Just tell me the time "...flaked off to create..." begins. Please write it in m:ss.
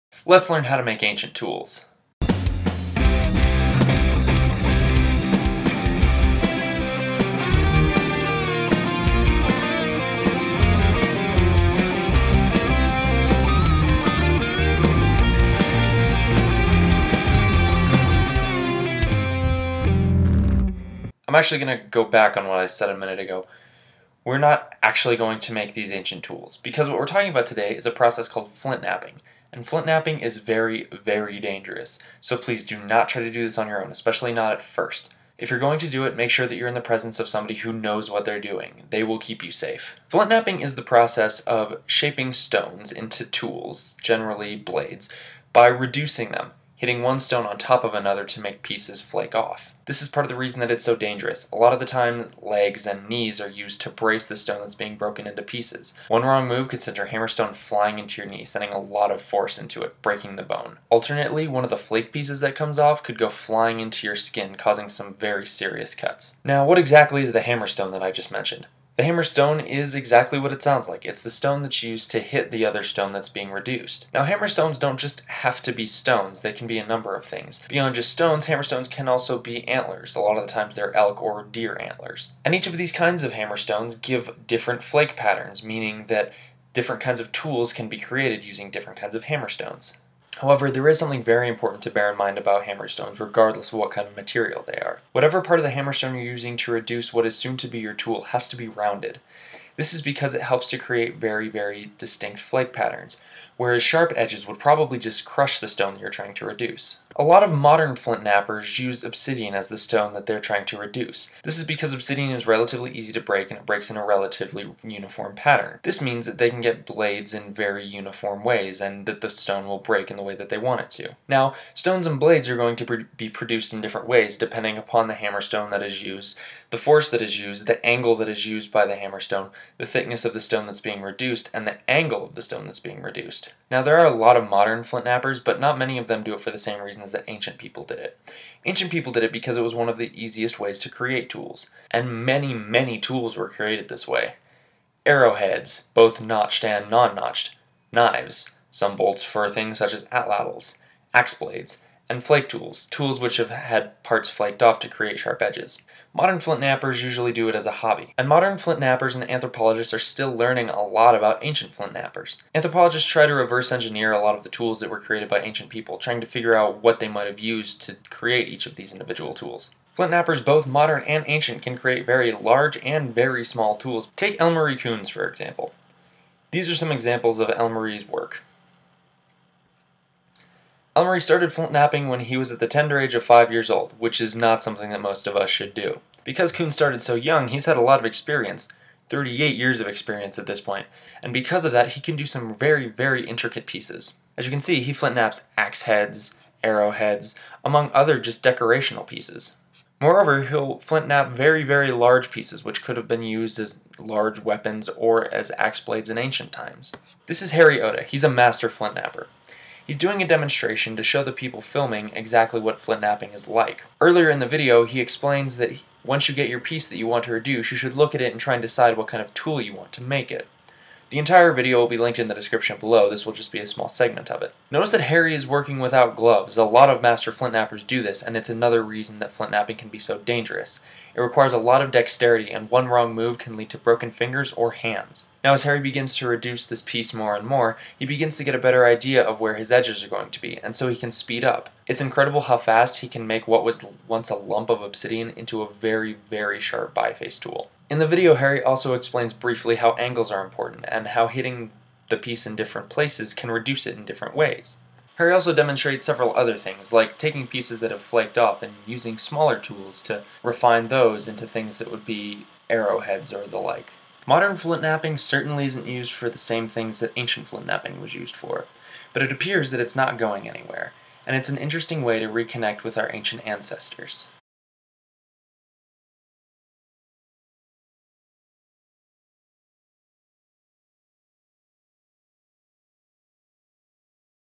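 2:34.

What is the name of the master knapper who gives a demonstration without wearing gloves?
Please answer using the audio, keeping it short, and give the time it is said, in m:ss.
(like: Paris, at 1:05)
Harry Oda, at 3:27.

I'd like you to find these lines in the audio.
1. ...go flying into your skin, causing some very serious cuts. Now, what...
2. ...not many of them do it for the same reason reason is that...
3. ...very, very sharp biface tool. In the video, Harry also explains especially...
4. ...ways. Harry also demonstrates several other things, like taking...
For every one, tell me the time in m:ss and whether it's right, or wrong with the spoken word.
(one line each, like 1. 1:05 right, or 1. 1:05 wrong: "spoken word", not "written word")
1. 1:03 right
2. 2:15 right
3. 4:05 wrong: "briefly", not "especially"
4. 4:14 right.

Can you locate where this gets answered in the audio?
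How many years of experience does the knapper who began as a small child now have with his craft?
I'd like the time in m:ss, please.
3:09.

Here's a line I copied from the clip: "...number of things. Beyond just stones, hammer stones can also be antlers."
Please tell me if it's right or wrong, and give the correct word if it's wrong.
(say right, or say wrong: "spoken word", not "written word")
right.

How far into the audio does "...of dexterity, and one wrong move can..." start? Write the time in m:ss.
3:51.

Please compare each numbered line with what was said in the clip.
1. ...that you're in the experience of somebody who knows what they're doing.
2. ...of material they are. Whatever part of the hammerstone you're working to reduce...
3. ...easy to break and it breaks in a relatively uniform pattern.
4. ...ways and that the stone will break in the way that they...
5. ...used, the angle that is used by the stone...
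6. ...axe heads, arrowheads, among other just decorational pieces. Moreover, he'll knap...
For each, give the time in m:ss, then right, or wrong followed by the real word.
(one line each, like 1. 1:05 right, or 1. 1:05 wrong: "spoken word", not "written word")
1. 0:36 wrong: "presence", not "experience"
2. 1:34 wrong: "using", not "working"
3. 1:52 right
4. 1:58 right
5. 2:07 wrong: "hammerstone", not "stone"
6. 3:15 right.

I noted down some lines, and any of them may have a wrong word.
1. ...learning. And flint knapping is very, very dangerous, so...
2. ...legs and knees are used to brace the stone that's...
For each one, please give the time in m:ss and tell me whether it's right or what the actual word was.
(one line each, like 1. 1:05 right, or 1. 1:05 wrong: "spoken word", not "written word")
1. 0:28 wrong: "knapping", not "learning"
2. 0:52 right.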